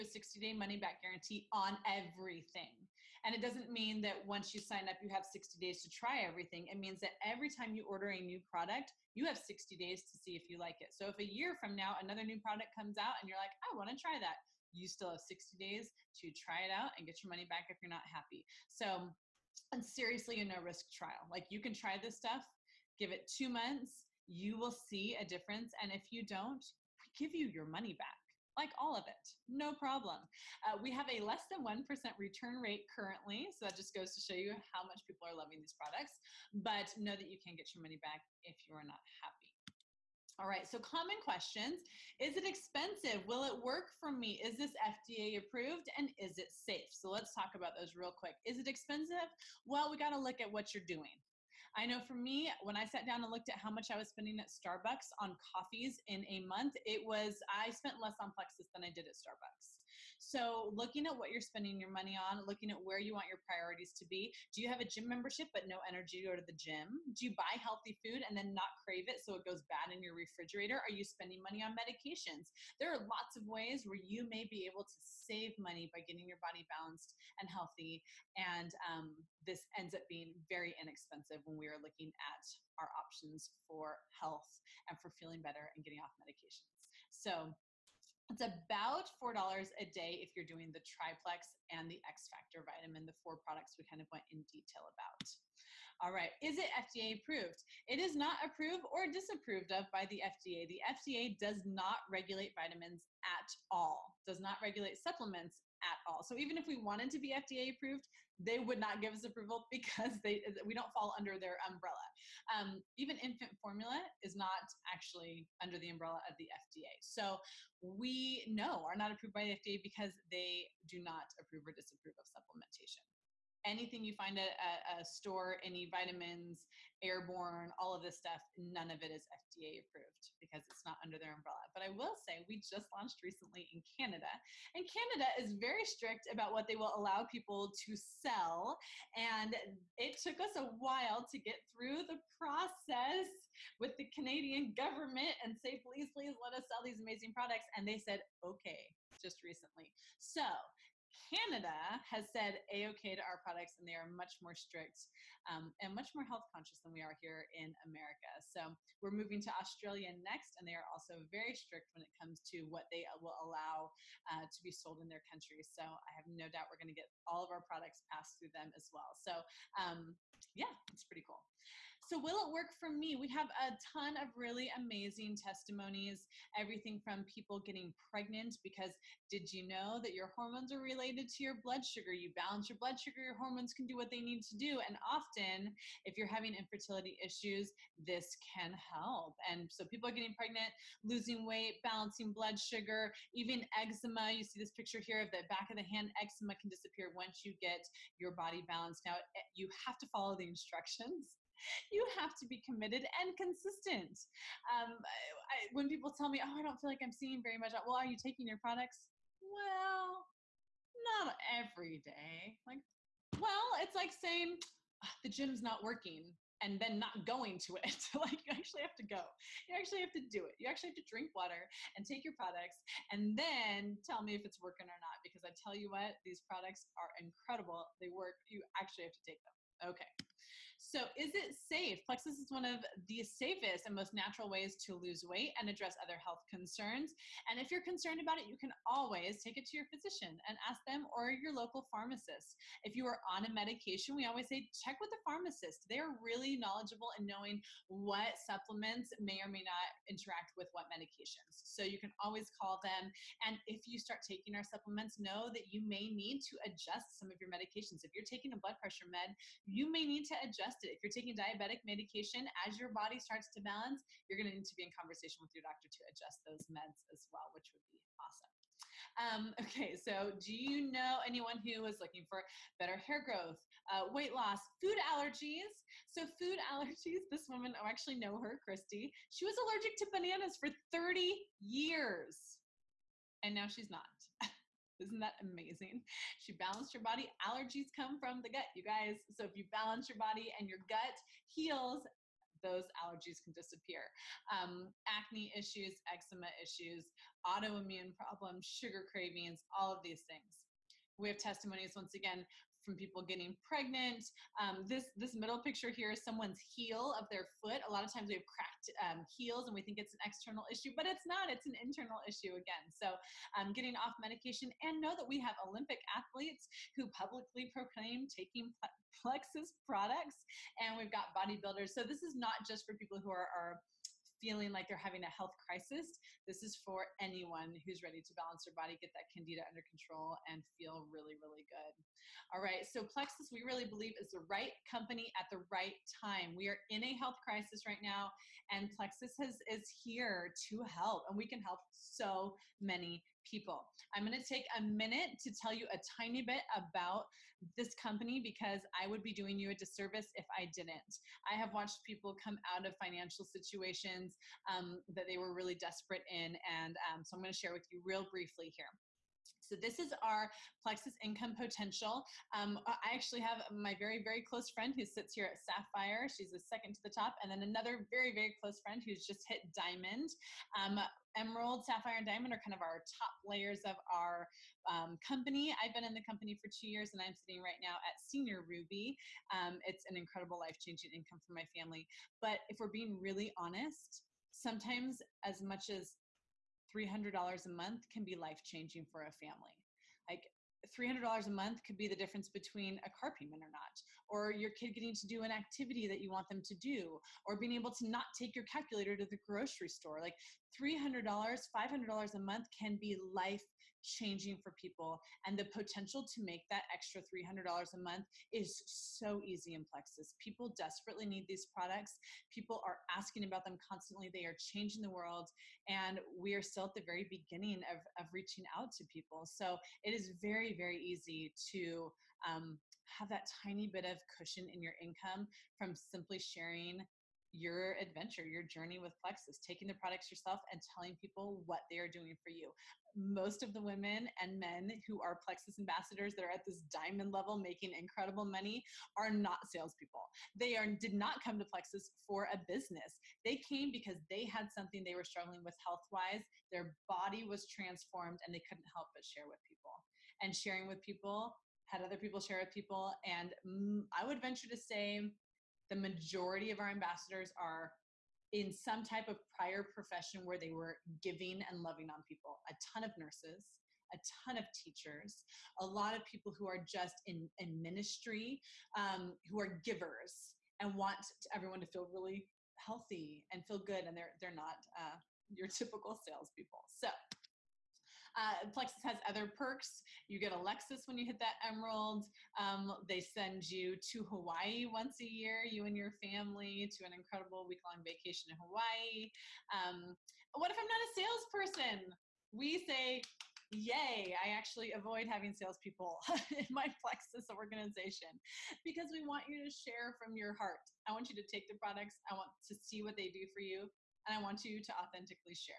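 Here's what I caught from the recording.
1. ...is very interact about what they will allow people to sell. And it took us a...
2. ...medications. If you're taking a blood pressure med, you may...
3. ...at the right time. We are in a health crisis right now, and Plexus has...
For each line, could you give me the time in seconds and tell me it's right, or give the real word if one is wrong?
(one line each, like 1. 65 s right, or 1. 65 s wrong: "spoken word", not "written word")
1. 135 s wrong: "strict", not "interact"
2. 257 s right
3. 335 s right.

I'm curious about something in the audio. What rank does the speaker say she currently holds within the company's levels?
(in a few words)
Senior Ruby.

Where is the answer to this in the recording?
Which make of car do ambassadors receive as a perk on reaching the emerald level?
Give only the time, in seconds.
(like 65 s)
480 s.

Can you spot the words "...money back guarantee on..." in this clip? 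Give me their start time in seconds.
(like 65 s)
0 s.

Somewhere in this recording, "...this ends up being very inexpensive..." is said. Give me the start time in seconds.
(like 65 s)
79 s.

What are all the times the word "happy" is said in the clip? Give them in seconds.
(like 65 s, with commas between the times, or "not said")
18 s, 39 s.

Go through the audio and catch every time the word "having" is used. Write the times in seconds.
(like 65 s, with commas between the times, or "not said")
186 s, 324 s, 495 s.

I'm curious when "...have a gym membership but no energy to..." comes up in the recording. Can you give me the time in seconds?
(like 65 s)
64 s.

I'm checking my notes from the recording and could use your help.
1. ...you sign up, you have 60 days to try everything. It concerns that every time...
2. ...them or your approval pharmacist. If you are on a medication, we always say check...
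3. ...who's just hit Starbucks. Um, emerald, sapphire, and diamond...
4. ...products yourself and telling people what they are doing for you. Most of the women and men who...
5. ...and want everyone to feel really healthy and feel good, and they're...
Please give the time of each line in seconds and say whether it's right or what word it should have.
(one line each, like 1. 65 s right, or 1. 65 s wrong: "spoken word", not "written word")
1. 4 s wrong: "means", not "concerns"
2. 240 s wrong: "local", not "approval"
3. 369 s wrong: "Diamond", not "Starbucks"
4. 429 s right
5. 470 s right.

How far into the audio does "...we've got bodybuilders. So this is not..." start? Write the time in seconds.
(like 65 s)
320 s.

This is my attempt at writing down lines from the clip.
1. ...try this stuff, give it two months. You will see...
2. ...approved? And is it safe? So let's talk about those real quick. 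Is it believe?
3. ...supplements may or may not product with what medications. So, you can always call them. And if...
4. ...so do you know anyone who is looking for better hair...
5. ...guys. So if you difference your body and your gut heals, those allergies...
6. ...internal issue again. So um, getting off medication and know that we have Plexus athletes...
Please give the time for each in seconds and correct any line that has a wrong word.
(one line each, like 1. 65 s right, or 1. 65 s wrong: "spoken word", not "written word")
1. 21 s right
2. 45 s wrong: "expensive", not "believe"
3. 248 s wrong: "interact", not "product"
4. 269 s right
5. 288 s wrong: "balance", not "difference"
6. 311 s wrong: "Olympic", not "Plexus".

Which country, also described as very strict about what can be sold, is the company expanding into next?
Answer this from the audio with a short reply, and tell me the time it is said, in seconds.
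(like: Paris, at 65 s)
Australia, at 159 s.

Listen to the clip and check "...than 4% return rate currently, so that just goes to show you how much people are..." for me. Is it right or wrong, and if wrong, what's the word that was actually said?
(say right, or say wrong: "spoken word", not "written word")
wrong: "1", not "4".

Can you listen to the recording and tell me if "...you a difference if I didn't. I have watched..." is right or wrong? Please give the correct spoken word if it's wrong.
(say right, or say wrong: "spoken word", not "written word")
wrong: "disservice", not "difference".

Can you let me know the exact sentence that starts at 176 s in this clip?
Everything from people getting pregnant because did you know that your hormones are related related to your blood sugar.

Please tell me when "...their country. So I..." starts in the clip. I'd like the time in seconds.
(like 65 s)
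165 s.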